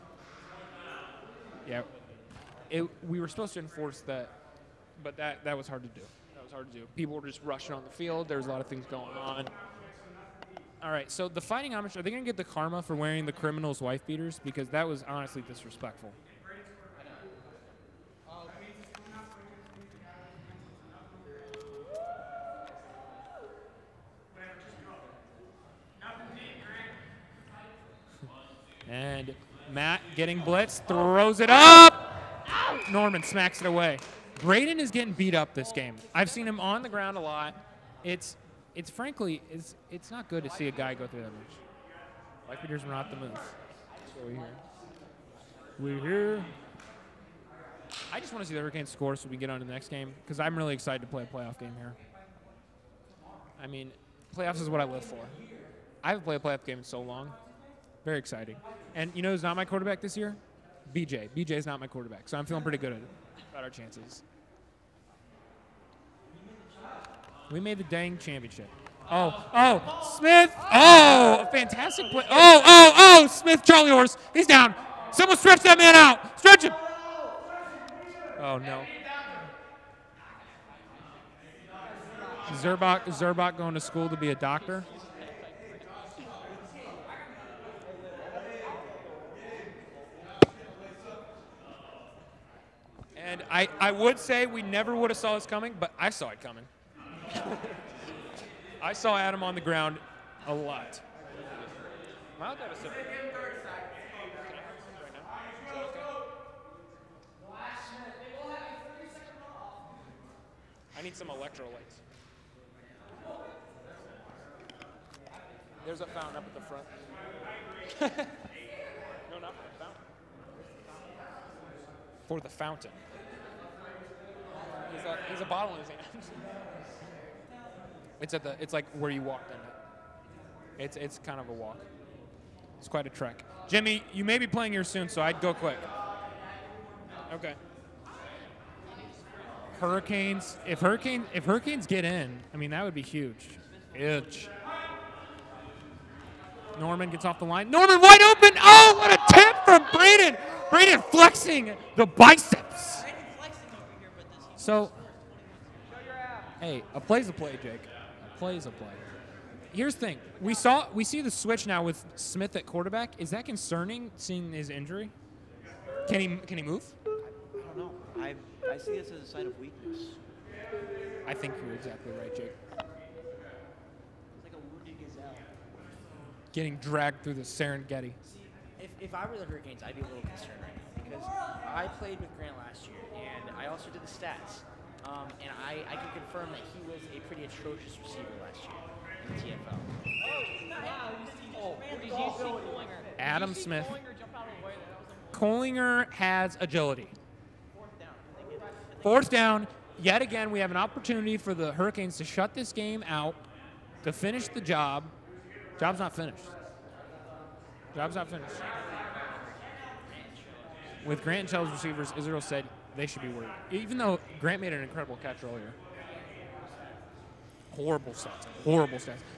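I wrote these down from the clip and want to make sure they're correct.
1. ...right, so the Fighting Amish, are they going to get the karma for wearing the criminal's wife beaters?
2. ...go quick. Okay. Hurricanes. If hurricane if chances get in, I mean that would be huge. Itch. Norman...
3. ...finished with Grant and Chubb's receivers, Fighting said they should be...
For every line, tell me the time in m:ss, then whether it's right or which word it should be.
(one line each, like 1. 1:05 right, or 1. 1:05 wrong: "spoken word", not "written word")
1. 0:10 right
2. 2:15 wrong: "hurricanes", not "chances"
3. 3:28 wrong: "Israel", not "Fighting".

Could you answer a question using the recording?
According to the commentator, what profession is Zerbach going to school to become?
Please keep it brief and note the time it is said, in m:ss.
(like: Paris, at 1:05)
Doctor, at 1:24.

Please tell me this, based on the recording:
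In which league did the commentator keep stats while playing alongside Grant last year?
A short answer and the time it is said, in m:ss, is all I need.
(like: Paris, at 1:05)
TFL, at 3:10.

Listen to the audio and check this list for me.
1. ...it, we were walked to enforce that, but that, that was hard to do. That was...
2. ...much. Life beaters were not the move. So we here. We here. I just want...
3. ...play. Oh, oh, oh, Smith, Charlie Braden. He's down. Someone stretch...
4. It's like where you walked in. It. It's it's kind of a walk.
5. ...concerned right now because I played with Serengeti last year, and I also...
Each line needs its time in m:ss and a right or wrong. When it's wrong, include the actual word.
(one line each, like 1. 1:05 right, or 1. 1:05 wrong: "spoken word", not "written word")
1. 0:02 wrong: "supposed", not "walked"
2. 0:41 wrong: "eaters", not "beaters"
3. 1:12 wrong: "Horse", not "Braden"
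4. 2:08 right
5. 3:00 wrong: "Grant", not "Serengeti".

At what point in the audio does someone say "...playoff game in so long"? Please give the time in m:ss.
0:56.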